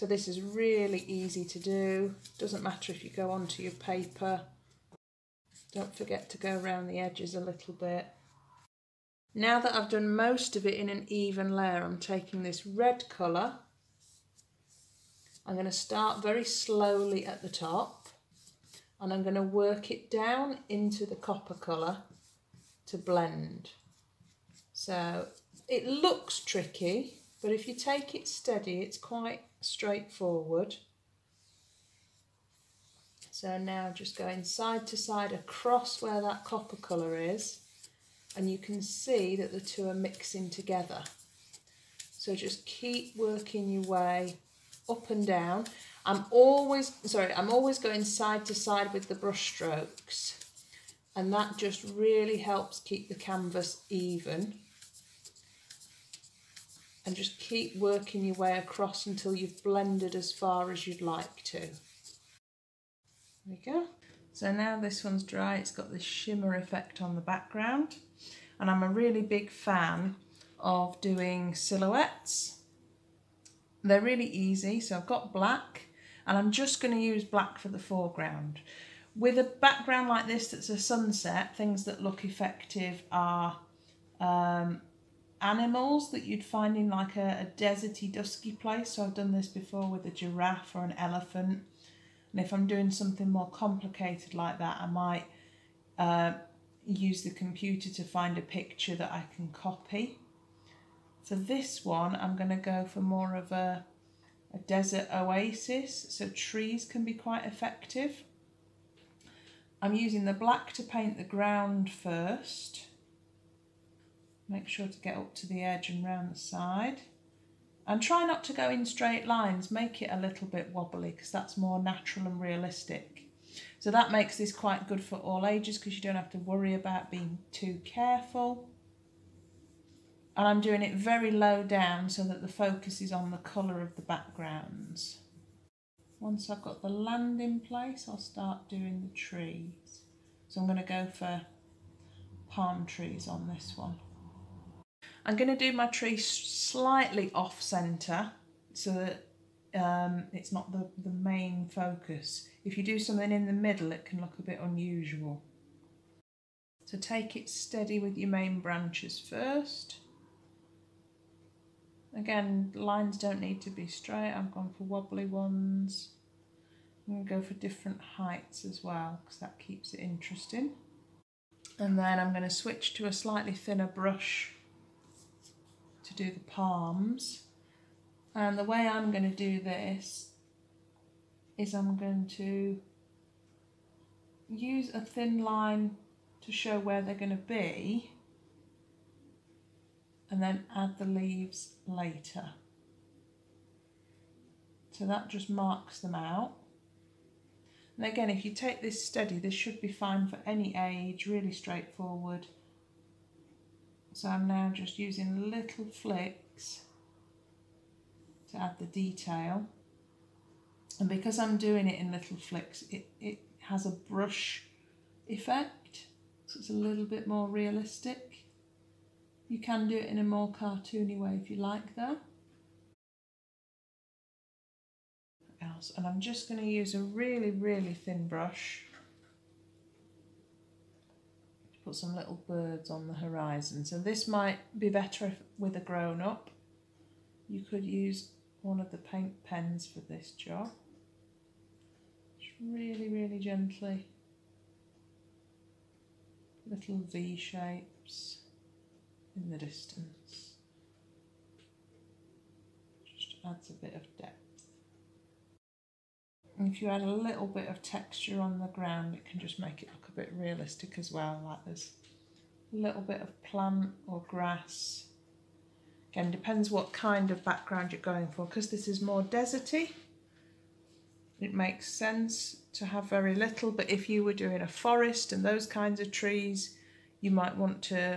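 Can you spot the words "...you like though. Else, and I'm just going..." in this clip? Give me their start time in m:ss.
3:41.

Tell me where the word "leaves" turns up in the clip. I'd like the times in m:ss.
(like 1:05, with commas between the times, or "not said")
3:11.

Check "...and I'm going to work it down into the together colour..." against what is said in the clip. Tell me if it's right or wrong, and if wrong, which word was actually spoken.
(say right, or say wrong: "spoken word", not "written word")
wrong: "copper", not "together".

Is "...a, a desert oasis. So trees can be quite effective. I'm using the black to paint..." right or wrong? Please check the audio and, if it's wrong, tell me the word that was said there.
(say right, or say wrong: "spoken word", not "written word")
right.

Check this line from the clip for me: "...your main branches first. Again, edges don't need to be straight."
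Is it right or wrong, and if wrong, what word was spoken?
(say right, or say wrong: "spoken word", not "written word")
wrong: "lines", not "edges".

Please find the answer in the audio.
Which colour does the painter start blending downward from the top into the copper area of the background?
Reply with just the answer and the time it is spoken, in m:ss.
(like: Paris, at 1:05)
red, at 0:12.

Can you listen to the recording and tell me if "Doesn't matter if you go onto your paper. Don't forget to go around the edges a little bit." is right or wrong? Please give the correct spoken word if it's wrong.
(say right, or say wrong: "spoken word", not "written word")
right.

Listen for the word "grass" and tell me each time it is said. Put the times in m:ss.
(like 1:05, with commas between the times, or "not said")
4:24.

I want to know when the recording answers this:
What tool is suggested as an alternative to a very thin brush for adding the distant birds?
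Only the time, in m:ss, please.
3:58.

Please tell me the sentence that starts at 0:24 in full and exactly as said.
So it looks tricky, but if you take it steady, it's quite straightforward.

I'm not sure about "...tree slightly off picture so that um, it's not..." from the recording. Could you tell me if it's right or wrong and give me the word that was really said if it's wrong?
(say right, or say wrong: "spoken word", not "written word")
wrong: "centre", not "picture".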